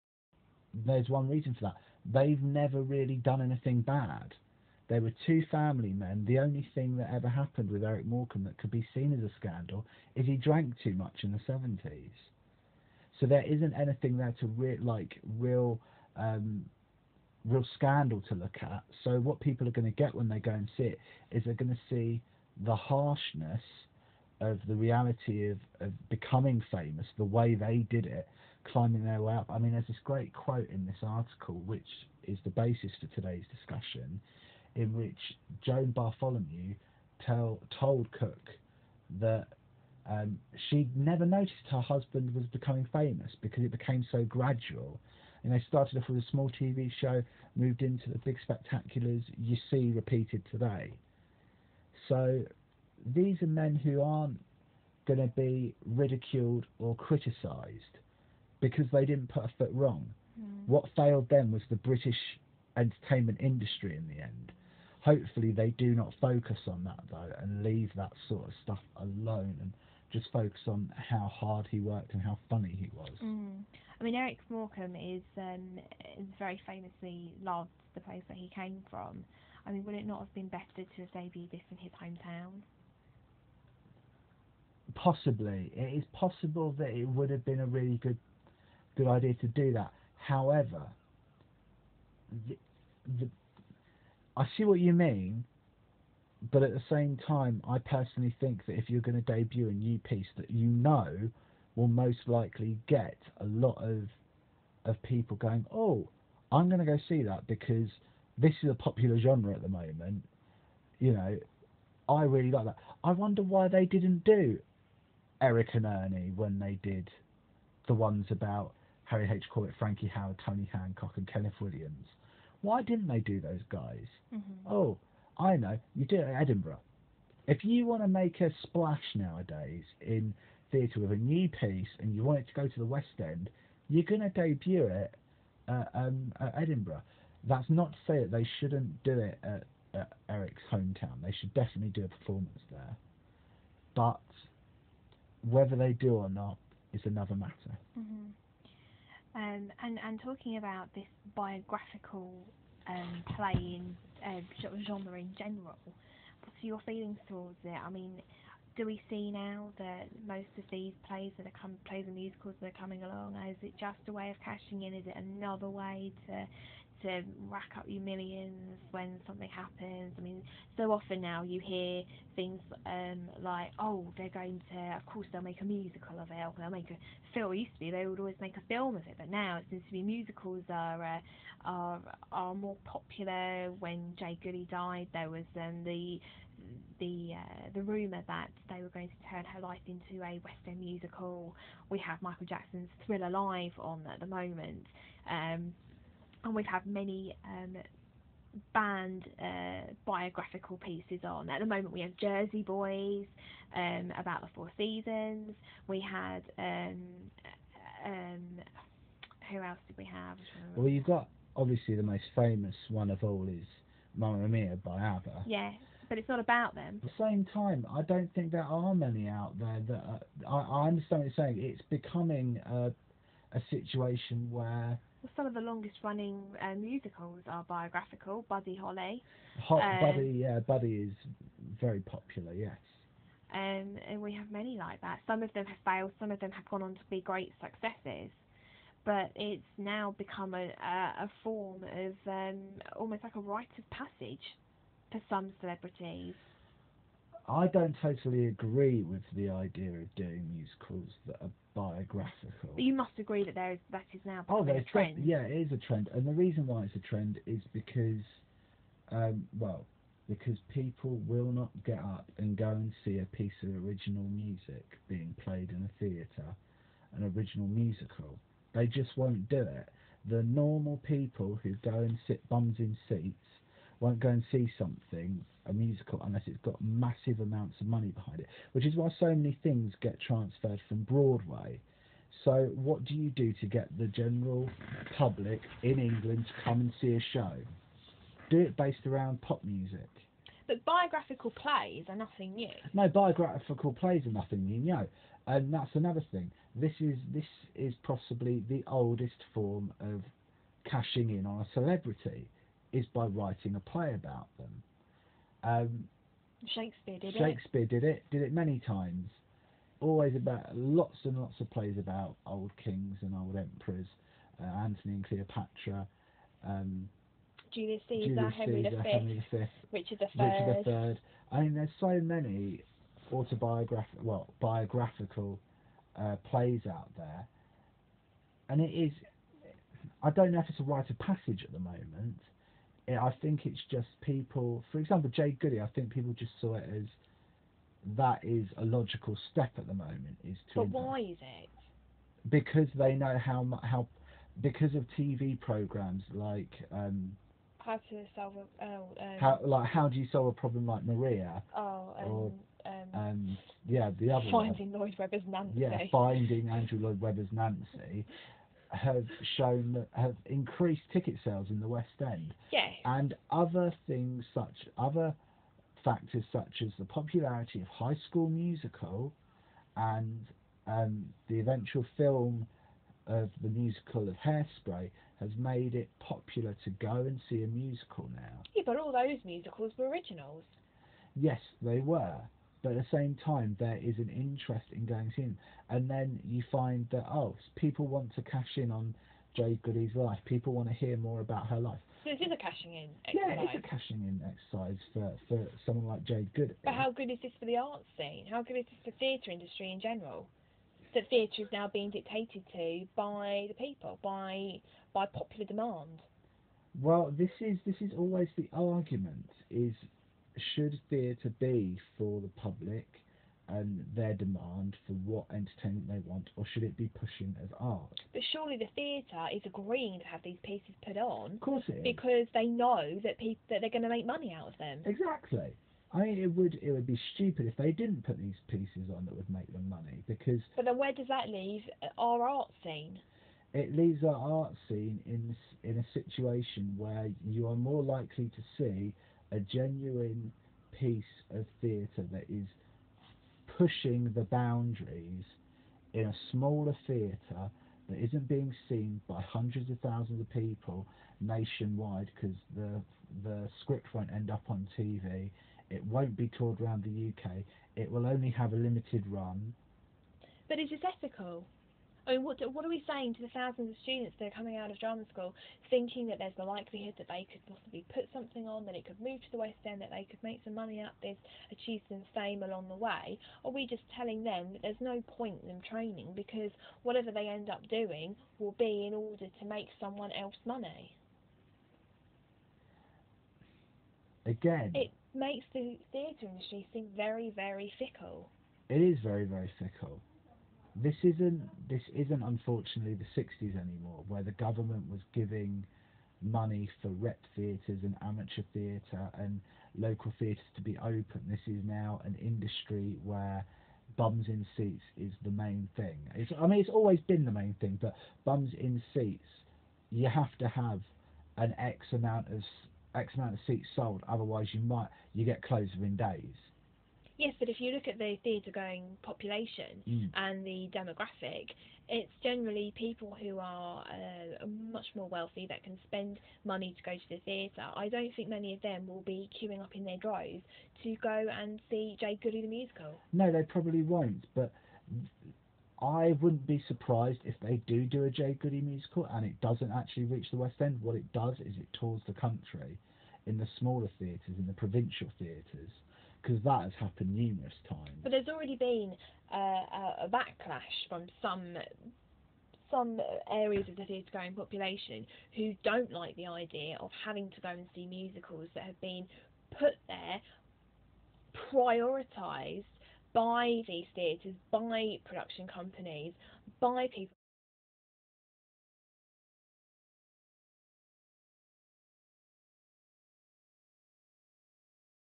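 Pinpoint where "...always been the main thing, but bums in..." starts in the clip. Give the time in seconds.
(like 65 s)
506 s.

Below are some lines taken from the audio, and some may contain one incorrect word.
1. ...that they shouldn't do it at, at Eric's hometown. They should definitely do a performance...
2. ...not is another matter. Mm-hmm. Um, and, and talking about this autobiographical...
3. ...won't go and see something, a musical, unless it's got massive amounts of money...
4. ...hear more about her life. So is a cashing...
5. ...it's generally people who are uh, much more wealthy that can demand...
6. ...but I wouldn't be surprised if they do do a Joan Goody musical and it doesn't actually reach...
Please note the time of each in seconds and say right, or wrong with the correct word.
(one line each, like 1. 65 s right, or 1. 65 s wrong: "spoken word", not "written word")
1. 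138 s right
2. 146 s wrong: "biographical", not "autobiographical"
3. 274 s right
4. 390 s right
5. 522 s wrong: "spend", not "demand"
6. 534 s wrong: "Jade", not "Joan".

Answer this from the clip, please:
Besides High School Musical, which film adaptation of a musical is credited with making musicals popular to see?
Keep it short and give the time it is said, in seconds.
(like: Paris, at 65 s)
Hairspray, at 374 s.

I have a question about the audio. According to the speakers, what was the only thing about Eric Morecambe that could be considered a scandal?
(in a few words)
He drank too much.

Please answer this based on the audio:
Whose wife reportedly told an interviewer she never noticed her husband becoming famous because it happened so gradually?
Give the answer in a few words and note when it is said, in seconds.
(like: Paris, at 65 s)
Joan Bartholomew, at 35 s.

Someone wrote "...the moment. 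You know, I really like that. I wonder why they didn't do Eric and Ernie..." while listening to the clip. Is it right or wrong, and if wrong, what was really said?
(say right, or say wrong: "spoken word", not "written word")
right.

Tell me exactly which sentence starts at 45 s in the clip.
And they started off with a small TV show, moved into the big spectaculars you see repeated today.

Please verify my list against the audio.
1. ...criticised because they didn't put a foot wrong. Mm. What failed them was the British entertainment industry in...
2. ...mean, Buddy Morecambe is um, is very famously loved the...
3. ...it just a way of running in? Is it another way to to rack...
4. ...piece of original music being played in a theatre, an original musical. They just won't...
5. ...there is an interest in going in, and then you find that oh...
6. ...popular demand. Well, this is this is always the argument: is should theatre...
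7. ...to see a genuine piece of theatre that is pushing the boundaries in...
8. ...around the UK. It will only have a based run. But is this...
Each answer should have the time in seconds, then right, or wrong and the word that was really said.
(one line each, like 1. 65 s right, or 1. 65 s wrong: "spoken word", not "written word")
1. 56 s right
2. 74 s wrong: "Eric", not "Buddy"
3. 163 s wrong: "cashing", not "running"
4. 263 s right
5. 383 s right
6. 405 s right
7. 438 s right
8. 456 s wrong: "limited", not "based".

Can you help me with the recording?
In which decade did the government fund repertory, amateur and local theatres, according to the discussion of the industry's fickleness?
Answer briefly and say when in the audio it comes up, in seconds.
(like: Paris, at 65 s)
The 60s, at 493 s.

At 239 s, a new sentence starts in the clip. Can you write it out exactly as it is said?
But it's now become a, a, a form of um, almost like a rite of passage for some celebrities.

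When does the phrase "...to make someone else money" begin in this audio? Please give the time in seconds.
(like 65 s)
479 s.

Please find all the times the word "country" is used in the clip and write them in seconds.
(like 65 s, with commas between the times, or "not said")
542 s.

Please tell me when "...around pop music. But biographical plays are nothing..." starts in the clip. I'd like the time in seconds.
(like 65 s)
289 s.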